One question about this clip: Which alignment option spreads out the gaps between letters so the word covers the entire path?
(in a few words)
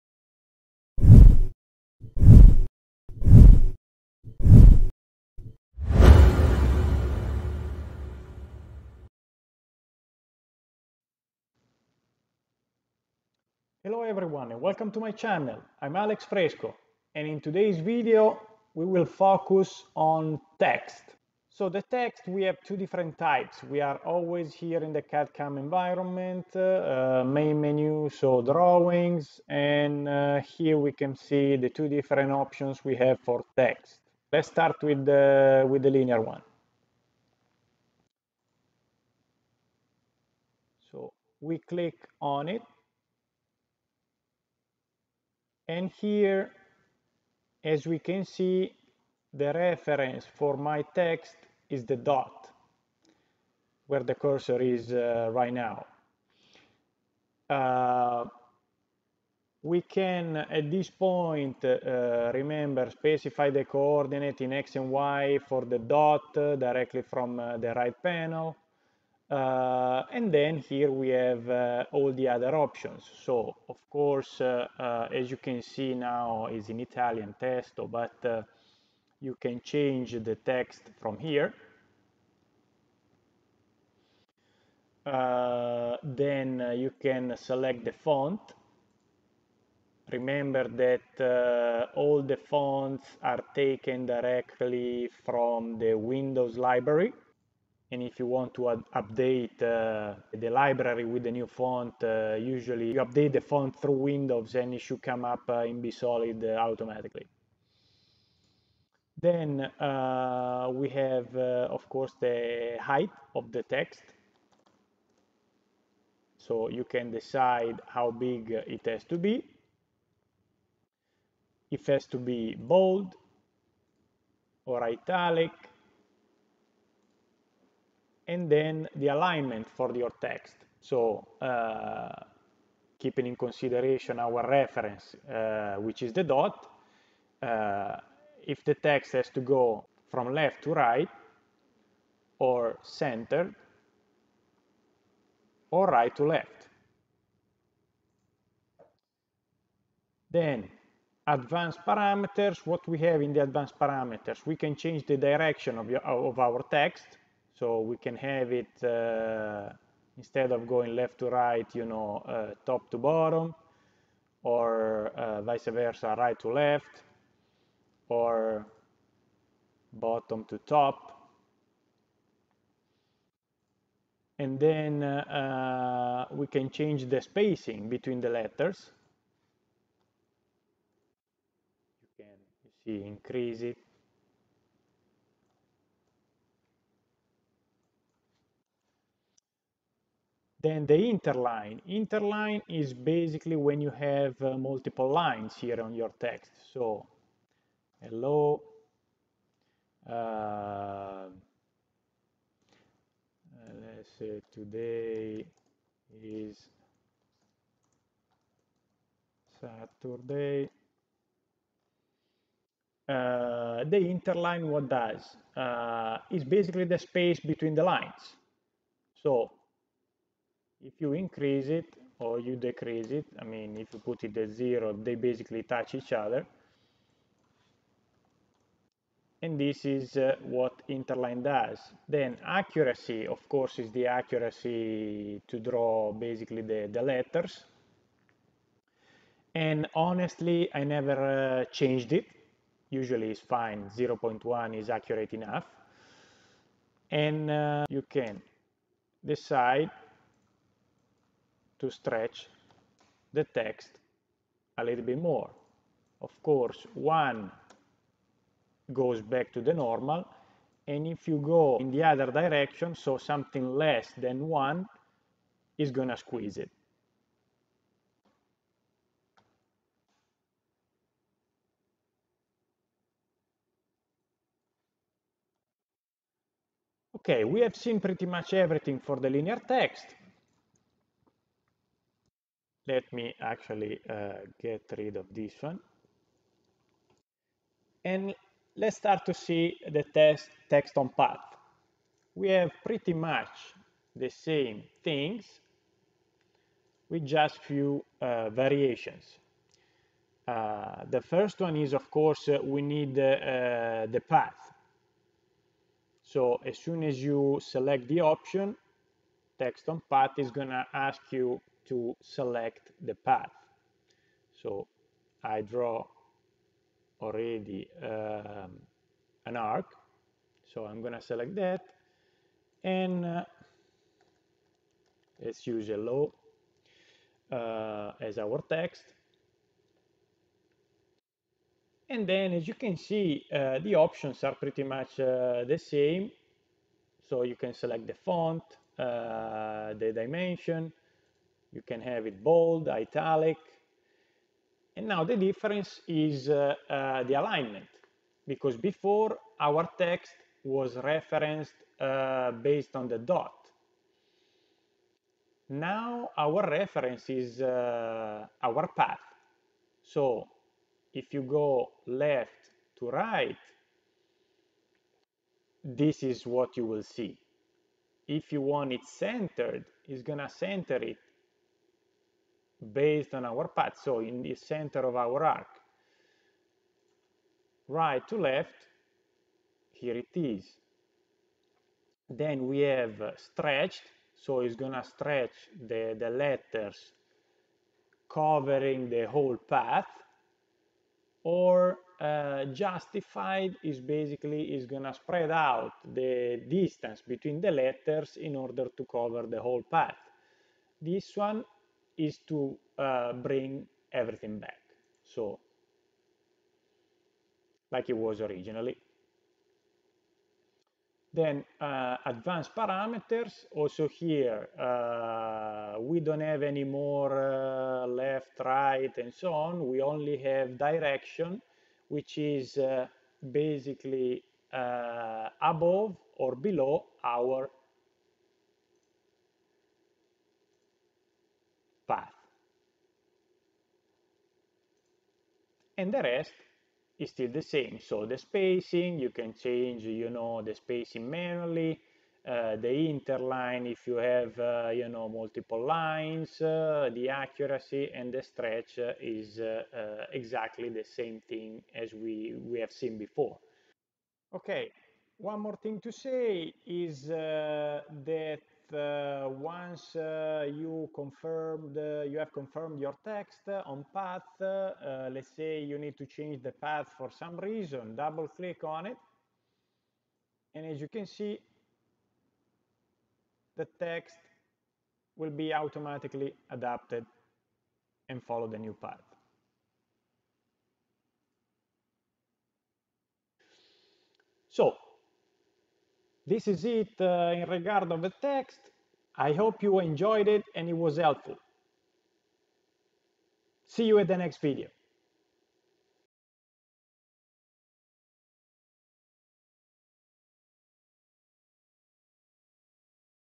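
Justified.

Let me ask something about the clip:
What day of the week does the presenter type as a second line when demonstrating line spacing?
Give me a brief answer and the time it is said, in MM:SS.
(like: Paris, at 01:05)
Saturday, at 03:29.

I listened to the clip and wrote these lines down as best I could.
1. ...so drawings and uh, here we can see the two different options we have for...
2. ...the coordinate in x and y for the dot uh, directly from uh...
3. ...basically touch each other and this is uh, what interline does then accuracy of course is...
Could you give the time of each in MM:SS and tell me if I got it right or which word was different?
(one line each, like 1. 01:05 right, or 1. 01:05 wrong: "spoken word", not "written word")
1. 00:28 right
2. 01:03 right
3. 03:45 right.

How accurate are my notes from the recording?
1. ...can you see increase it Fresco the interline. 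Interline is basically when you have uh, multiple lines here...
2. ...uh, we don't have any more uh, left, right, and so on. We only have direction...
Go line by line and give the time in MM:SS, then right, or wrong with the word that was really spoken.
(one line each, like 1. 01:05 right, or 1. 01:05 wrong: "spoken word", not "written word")
1. 03:02 wrong: "Then", not "Fresco"
2. 06:54 right.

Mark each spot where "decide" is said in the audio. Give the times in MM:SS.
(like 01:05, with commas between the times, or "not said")
01:57, 04:09.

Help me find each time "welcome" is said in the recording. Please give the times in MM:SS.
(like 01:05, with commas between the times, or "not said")
00:14.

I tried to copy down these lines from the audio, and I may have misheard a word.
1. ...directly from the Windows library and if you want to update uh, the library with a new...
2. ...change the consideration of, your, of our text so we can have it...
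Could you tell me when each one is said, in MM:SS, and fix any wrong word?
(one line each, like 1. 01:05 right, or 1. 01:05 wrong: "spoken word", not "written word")
1. 01:34 right
2. 02:34 wrong: "direction", not "consideration".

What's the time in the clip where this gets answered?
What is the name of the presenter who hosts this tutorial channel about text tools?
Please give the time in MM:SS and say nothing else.
00:15.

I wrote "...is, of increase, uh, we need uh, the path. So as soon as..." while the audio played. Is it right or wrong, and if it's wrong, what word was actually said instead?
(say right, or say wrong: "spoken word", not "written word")
wrong: "course", not "increase".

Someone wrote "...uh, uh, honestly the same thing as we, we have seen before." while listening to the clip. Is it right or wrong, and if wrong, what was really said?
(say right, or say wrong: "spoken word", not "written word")
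wrong: "exactly", not "honestly".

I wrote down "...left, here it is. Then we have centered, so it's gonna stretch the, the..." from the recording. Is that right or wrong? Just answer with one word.
wrong.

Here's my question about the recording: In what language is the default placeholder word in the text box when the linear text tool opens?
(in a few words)
Italian.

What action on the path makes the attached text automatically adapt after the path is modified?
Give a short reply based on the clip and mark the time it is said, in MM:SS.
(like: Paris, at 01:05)
Double click, at 07:48.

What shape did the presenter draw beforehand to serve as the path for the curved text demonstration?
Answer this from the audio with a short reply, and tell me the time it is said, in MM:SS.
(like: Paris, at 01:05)
An arc, at 05:19.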